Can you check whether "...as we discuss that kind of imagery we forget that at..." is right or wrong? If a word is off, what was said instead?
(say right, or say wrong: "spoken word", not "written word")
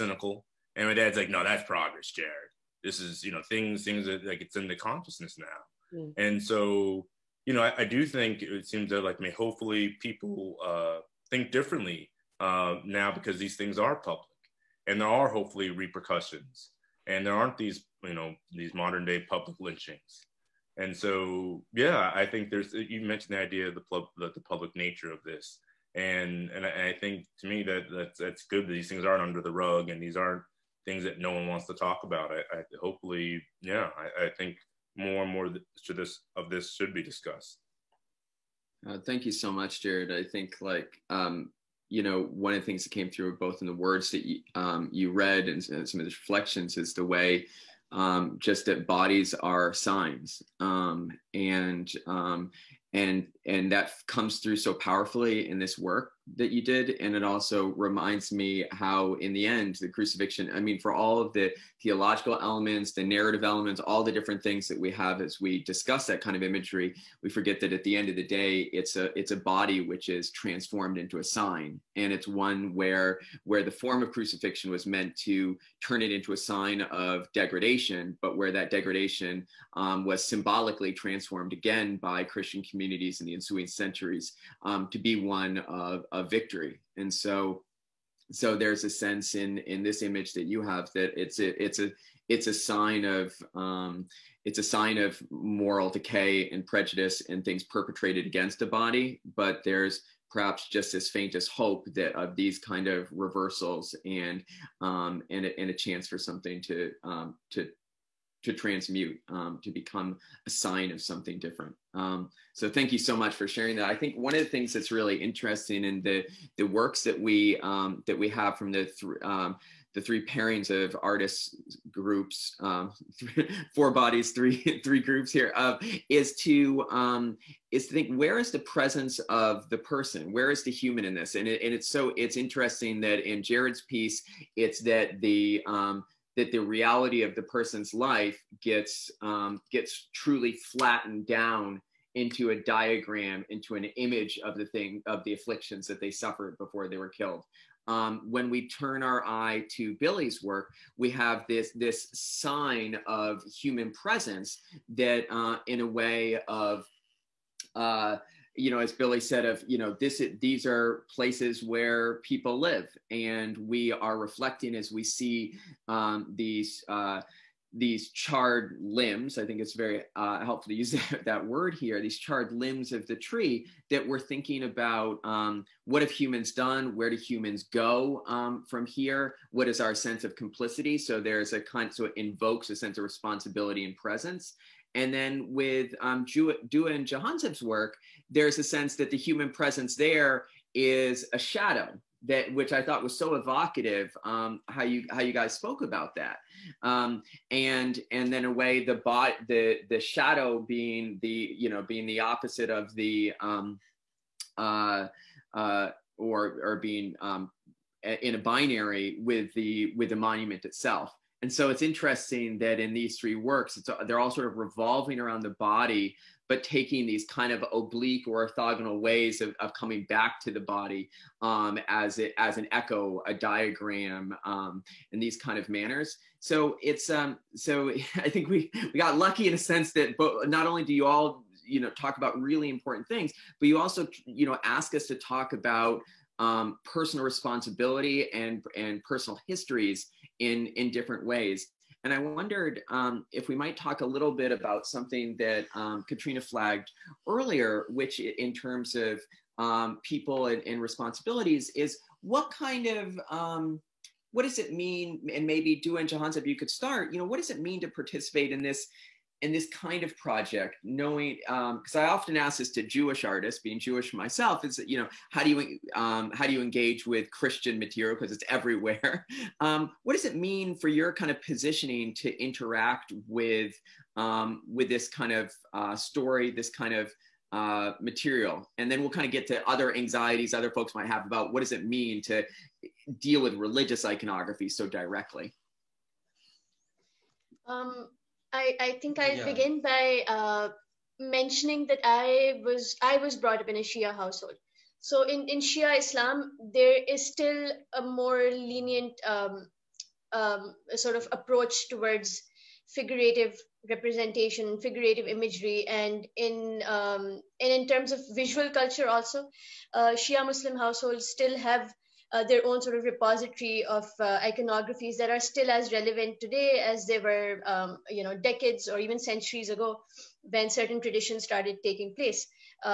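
right.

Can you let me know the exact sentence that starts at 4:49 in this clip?
begin by uh, mentioning that I was I was brought up in a Shia household.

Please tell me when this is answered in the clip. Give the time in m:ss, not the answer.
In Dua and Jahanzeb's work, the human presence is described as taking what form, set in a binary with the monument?
3:11.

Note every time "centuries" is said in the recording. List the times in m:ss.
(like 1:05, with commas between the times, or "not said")
1:23, 5:19.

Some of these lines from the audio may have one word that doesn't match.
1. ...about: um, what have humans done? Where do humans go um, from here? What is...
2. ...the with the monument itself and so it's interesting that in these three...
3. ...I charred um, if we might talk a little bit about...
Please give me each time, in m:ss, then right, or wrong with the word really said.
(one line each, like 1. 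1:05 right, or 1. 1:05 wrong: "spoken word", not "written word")
1. 2:54 right
2. 3:29 right
3. 4:02 wrong: "wondered", not "charred".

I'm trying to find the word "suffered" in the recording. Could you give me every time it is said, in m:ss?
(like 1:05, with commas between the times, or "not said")
2:26.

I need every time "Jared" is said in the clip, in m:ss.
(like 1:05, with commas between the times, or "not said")
0:02, 0:39, 2:13.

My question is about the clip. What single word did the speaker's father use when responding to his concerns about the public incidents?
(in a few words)
progress.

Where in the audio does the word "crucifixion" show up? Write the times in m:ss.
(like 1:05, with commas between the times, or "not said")
0:59, 1:14.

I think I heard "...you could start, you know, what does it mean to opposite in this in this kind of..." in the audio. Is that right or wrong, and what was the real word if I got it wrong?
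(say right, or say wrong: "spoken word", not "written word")
wrong: "participate", not "opposite".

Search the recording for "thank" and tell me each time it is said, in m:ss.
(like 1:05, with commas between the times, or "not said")
0:38, 1:52.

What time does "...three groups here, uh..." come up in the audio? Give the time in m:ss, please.
2:04.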